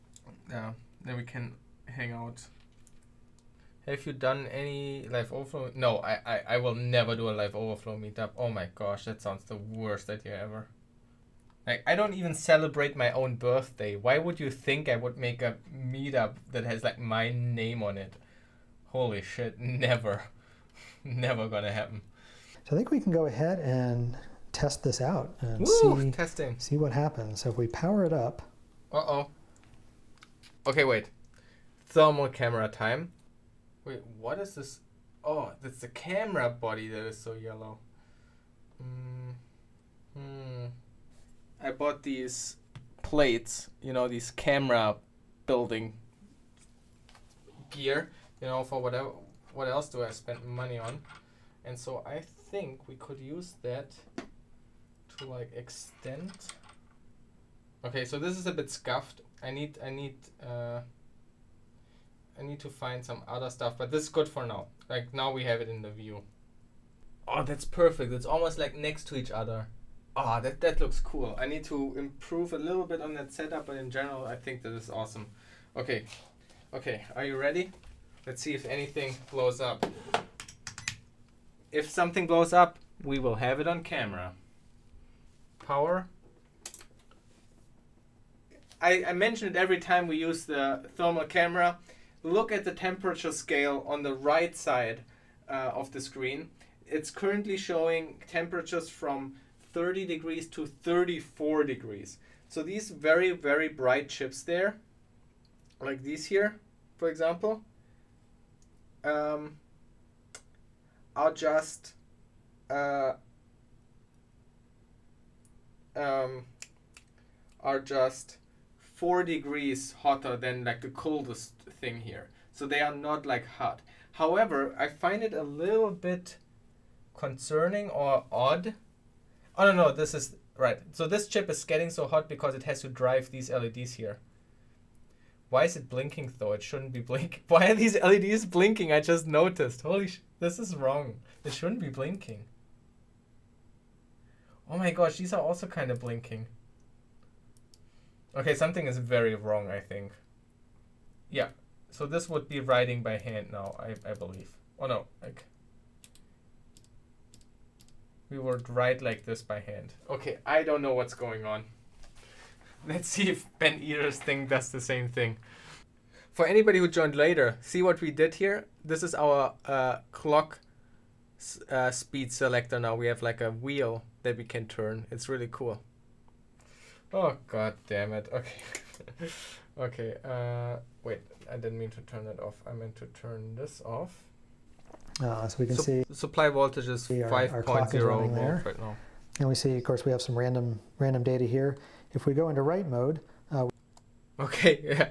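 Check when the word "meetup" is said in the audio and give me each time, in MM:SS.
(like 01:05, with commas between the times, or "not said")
00:07, 00:15.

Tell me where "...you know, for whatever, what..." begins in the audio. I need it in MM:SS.
00:48.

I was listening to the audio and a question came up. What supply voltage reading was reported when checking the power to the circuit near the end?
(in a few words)
5.0 volts.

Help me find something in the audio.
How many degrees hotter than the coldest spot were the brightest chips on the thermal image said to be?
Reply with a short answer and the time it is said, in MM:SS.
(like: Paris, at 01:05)
4, at 01:58.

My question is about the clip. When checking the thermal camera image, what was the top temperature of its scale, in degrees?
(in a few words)
34.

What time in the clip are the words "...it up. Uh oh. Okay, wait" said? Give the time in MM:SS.
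00:28.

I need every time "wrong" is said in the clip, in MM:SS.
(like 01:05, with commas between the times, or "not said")
02:20, 02:29.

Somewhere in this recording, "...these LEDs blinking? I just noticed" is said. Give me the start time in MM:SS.
02:17.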